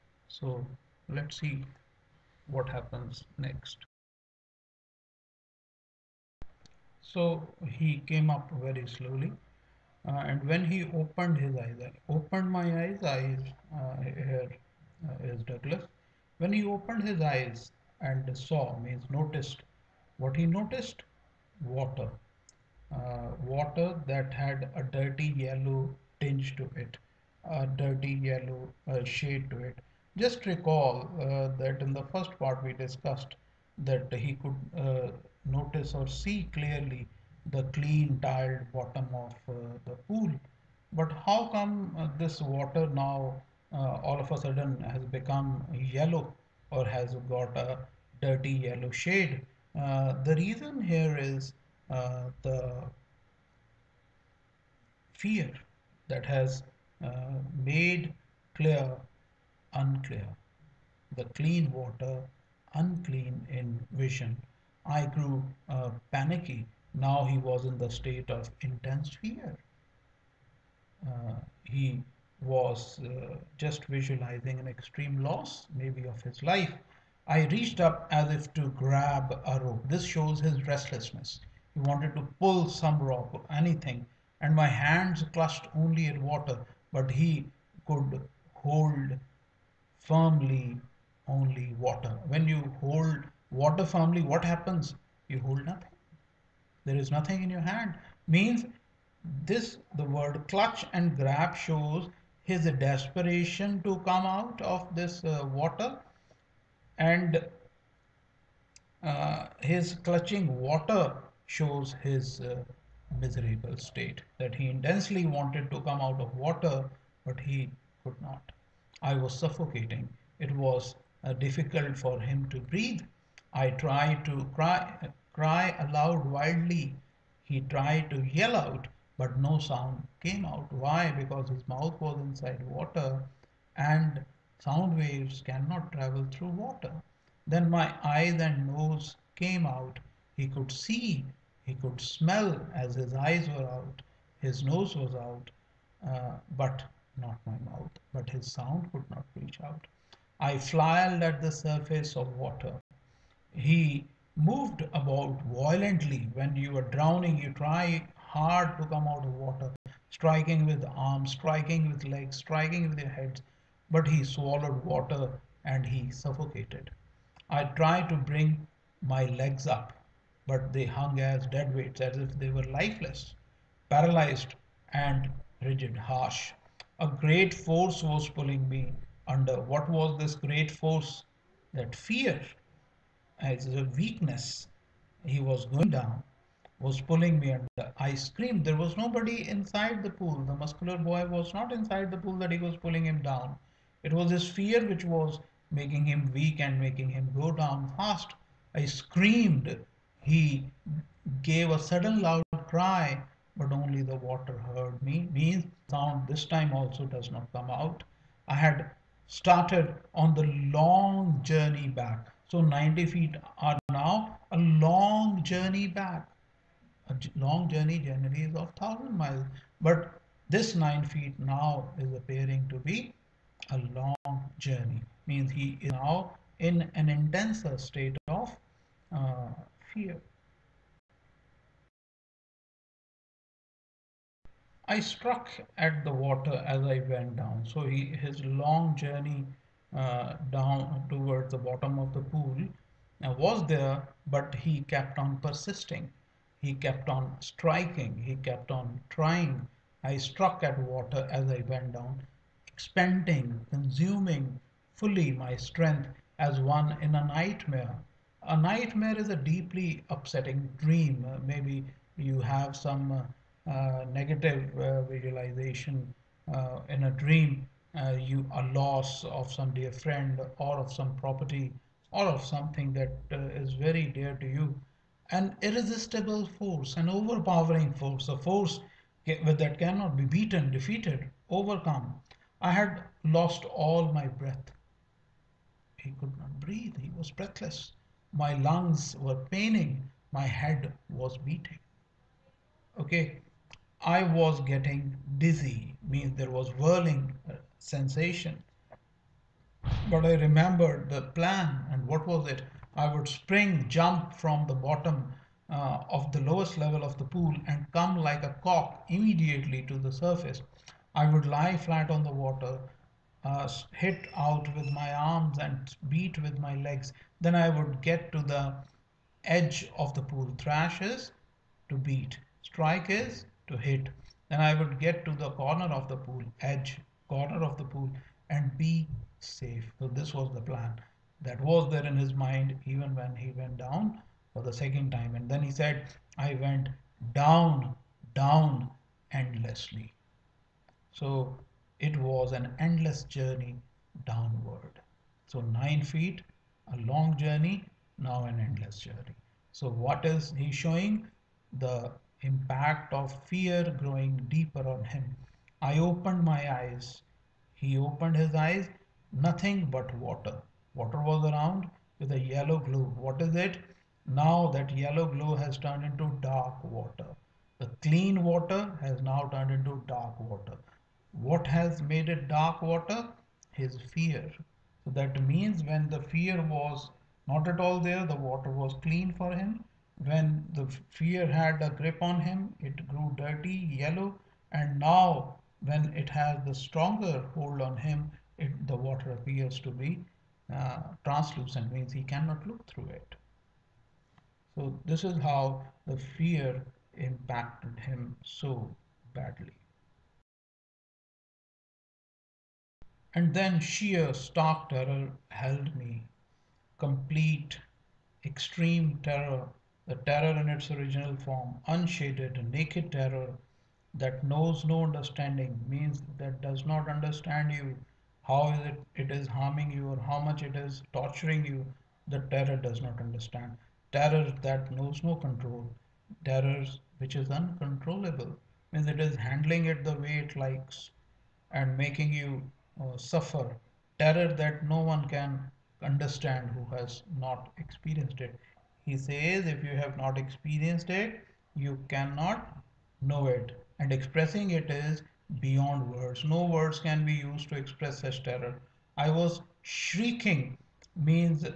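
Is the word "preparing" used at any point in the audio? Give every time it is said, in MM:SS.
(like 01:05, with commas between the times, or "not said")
not said.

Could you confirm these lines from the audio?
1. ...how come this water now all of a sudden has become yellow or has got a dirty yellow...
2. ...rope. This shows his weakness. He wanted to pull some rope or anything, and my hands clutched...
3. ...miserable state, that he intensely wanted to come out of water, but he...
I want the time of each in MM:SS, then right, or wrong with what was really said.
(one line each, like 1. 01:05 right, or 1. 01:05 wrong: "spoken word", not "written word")
1. 00:41 right
2. 01:19 wrong: "restlessness", not "weakness"
3. 01:53 right.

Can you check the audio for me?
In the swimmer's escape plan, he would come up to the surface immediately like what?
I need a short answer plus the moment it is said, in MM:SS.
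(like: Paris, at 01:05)
a cock, at 05:08.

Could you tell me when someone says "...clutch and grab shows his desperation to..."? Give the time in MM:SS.
01:40.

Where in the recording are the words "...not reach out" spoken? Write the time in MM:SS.
02:29.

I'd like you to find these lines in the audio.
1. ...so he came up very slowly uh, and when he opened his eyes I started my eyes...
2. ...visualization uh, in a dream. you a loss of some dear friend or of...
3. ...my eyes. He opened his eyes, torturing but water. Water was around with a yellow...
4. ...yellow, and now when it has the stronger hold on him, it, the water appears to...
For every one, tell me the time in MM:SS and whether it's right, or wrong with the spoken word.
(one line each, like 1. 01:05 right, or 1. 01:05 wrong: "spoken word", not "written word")
1. 00:07 wrong: "opened", not "started"
2. 04:25 right
3. 05:56 wrong: "nothing", not "torturing"
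4. 06:23 right.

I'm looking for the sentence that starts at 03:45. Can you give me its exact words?
Means he is now in an intenser state of uh, fear.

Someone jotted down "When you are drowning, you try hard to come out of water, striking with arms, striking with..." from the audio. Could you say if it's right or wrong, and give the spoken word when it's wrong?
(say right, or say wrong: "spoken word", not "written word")
right.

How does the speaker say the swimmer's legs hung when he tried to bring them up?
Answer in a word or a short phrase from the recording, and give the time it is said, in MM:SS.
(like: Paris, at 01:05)
as dead weights, at 02:51.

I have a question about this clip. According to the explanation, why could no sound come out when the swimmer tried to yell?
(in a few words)
sound waves cannot travel through water.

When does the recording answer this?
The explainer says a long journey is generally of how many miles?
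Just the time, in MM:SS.
03:38.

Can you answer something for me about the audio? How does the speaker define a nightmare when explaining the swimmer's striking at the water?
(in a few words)
a deeply upsetting dream.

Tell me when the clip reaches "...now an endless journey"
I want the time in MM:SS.
05:48.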